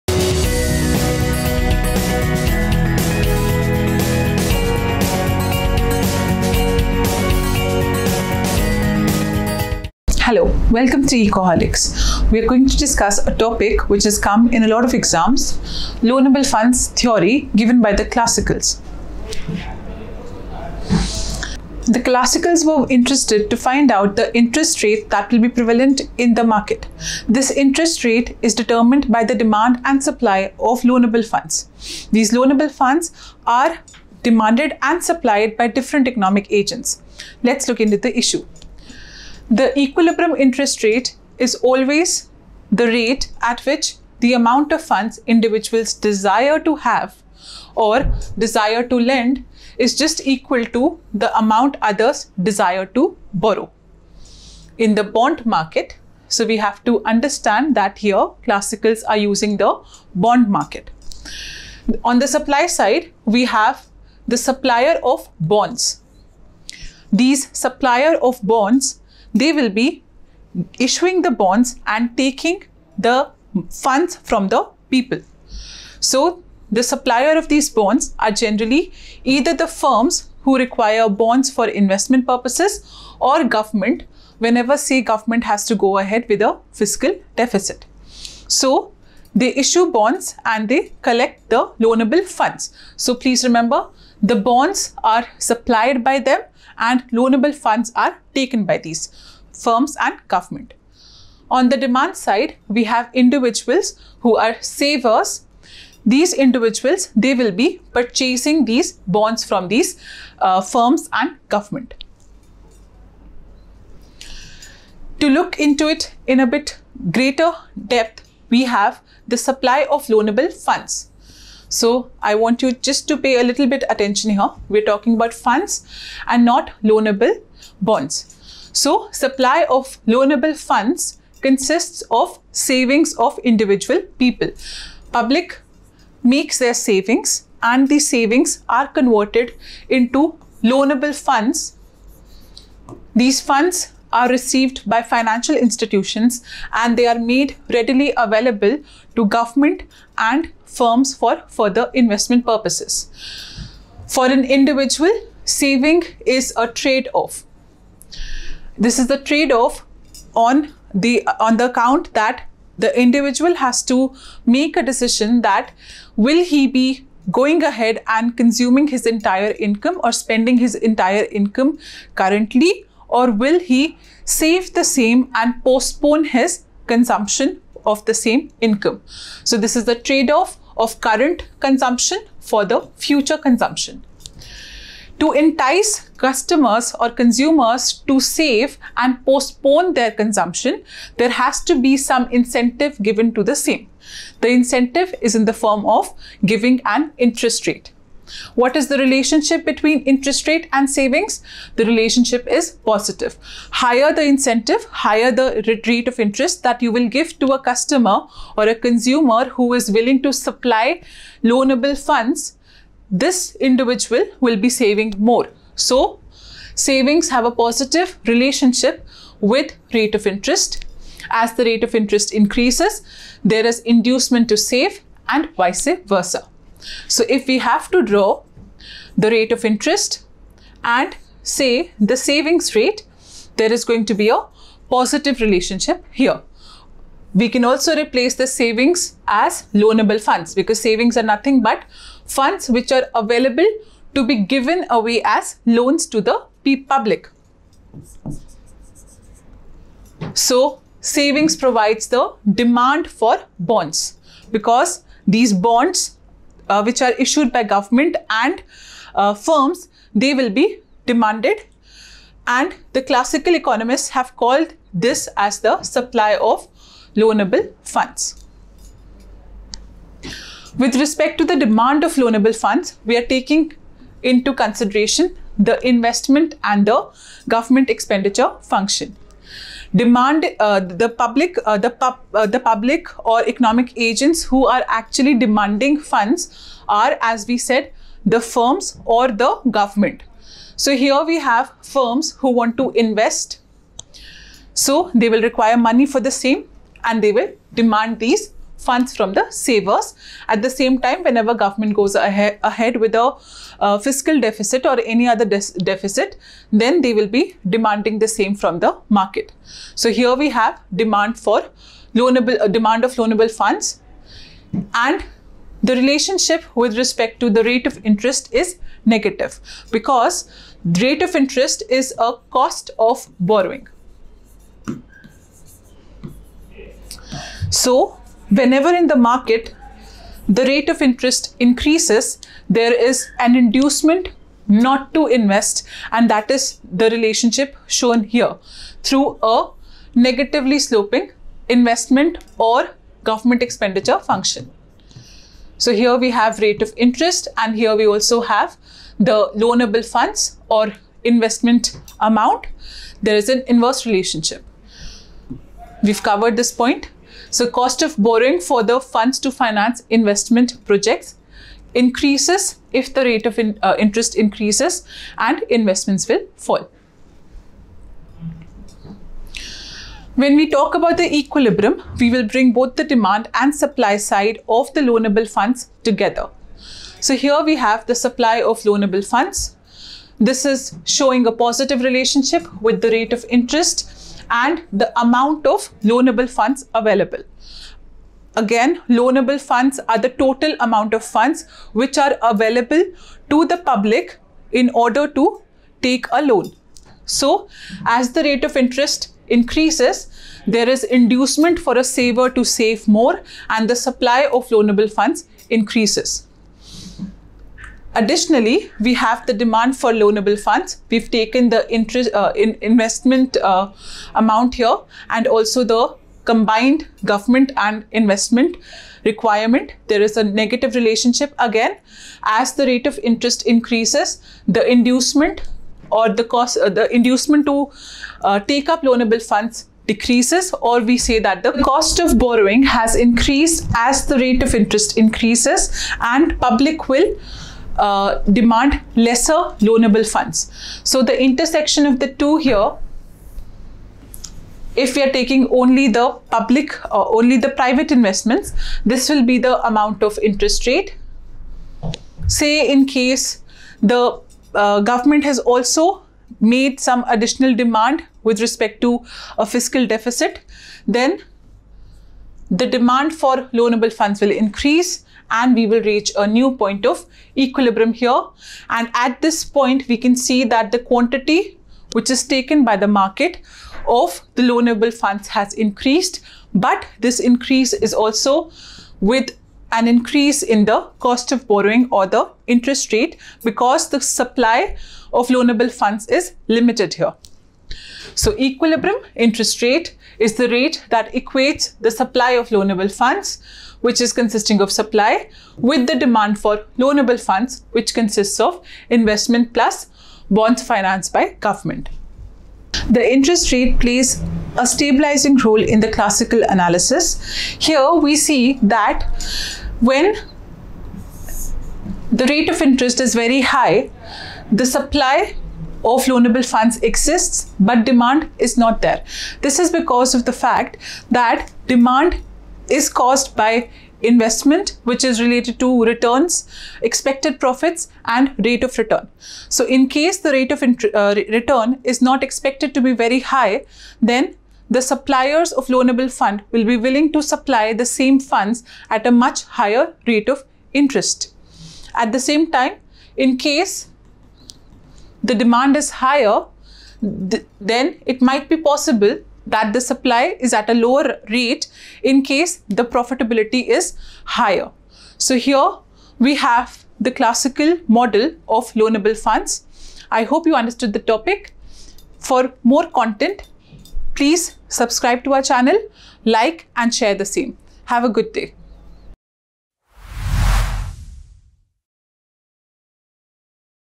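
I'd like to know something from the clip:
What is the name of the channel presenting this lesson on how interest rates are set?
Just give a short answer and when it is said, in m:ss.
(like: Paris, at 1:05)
Ecoholics, at 0:11.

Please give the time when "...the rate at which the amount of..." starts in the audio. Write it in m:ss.
0:42.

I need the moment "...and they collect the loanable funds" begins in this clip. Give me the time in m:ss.
1:30.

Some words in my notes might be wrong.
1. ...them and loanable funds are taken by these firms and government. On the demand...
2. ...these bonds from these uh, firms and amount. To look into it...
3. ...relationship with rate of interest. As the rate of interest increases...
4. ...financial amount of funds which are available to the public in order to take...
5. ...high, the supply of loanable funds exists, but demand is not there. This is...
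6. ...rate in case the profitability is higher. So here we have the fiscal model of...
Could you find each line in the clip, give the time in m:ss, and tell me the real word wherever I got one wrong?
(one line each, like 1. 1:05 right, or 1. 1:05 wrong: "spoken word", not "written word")
1. 1:36 right
2. 1:48 wrong: "government", not "amount"
3. 3:38 right
4. 6:30 wrong: "total", not "financial"
5. 8:33 right
6. 9:11 wrong: "classical", not "fiscal".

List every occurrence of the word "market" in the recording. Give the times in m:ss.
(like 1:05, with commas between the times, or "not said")
0:26, 0:55, 1:00, 5:09, 5:29, 7:53.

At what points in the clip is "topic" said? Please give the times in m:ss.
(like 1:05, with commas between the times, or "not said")
0:13, 9:21.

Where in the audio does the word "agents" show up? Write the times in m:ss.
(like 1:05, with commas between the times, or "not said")
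0:36, 4:43.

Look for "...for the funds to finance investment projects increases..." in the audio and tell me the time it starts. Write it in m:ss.
5:58.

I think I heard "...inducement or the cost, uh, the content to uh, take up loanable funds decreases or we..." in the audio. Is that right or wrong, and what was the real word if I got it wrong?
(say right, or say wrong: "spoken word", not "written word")
wrong: "inducement", not "content".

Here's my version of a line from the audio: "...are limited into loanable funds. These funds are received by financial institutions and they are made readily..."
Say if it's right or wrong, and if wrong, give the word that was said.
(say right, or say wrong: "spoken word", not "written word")
wrong: "converted", not "limited".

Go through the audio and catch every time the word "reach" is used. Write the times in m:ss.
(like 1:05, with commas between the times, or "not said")
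7:46.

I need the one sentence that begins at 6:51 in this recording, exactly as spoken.
We've taken the interest uh, in investment uh, amount here and also the combined government and investment requirement.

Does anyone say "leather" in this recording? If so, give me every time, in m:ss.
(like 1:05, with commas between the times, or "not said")
not said.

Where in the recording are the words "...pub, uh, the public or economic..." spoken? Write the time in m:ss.
4:41.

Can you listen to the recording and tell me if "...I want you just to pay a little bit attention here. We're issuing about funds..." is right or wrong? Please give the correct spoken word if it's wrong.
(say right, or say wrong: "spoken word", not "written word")
wrong: "talking", not "issuing".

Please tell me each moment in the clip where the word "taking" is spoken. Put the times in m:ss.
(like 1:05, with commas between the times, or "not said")
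1:12, 4:33, 7:25.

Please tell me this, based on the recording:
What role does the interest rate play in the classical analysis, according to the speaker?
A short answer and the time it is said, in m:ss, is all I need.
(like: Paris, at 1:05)
stabilizing role, at 8:24.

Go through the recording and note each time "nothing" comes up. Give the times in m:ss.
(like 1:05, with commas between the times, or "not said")
4:01.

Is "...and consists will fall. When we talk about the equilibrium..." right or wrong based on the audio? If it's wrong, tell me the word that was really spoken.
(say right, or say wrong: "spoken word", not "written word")
wrong: "investments", not "consists".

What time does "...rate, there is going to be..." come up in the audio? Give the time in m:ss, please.
3:52.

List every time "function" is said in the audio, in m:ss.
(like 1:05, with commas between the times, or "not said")
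4:38, 5:44.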